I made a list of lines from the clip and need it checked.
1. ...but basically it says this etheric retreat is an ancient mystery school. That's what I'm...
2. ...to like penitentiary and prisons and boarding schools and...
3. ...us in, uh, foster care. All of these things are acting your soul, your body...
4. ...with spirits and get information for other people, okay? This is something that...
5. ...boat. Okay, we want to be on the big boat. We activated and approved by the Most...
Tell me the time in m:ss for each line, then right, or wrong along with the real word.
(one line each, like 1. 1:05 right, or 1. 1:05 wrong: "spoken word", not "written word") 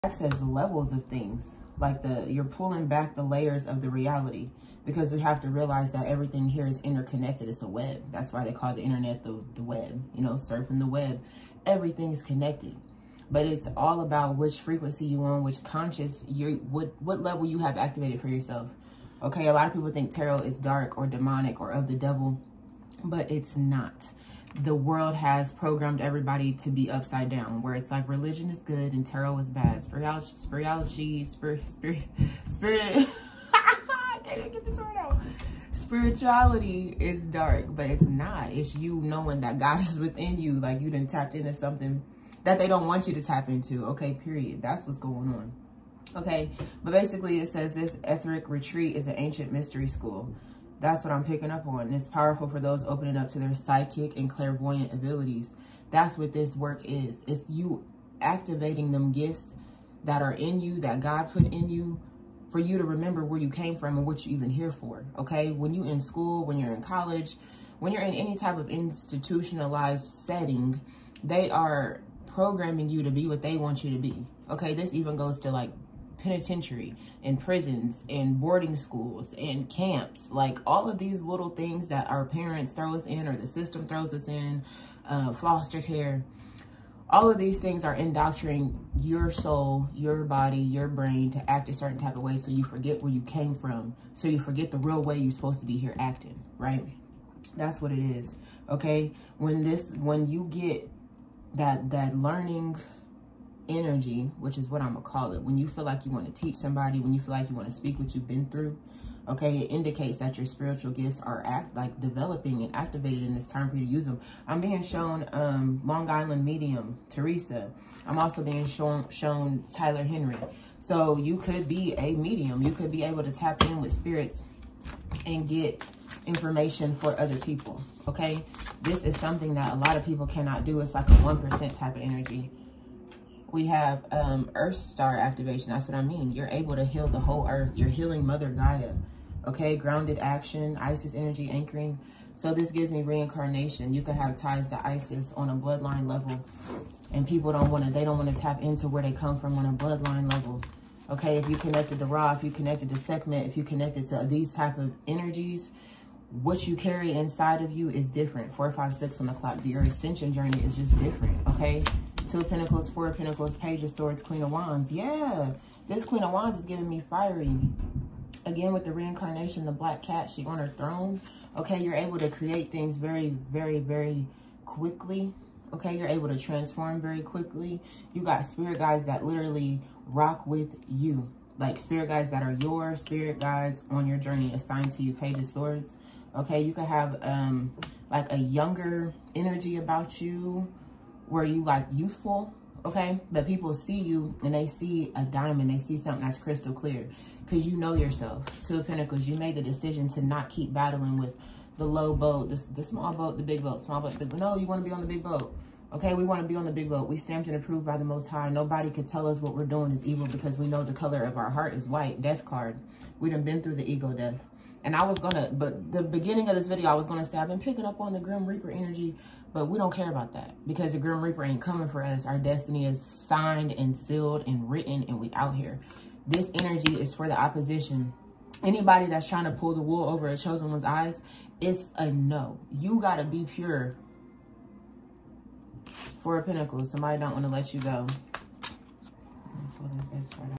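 1. 0:46 right
2. 1:15 right
3. 1:24 wrong: "indoctrinating", not "acting"
4. 2:03 right
5. 3:25 wrong: "stamped", not "activated".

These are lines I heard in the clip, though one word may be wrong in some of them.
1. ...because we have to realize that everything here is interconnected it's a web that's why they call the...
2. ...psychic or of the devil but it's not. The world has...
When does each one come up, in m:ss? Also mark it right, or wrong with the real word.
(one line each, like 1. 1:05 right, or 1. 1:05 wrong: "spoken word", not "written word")
1. 0:04 right
2. 0:21 wrong: "demonic", not "psychic".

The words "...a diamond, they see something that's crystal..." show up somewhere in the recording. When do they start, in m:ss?
3:15.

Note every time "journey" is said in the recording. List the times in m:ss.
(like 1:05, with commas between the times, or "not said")
2:40, 3:04.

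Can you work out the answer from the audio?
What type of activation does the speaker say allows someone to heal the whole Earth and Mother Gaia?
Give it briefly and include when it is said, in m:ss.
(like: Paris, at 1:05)
Earth Star activation, at 2:14.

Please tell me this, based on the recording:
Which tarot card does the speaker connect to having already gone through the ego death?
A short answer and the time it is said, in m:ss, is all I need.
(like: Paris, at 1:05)
Death card, at 3:32.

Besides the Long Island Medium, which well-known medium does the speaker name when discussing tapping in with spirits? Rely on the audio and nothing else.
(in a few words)
Tyler Henry.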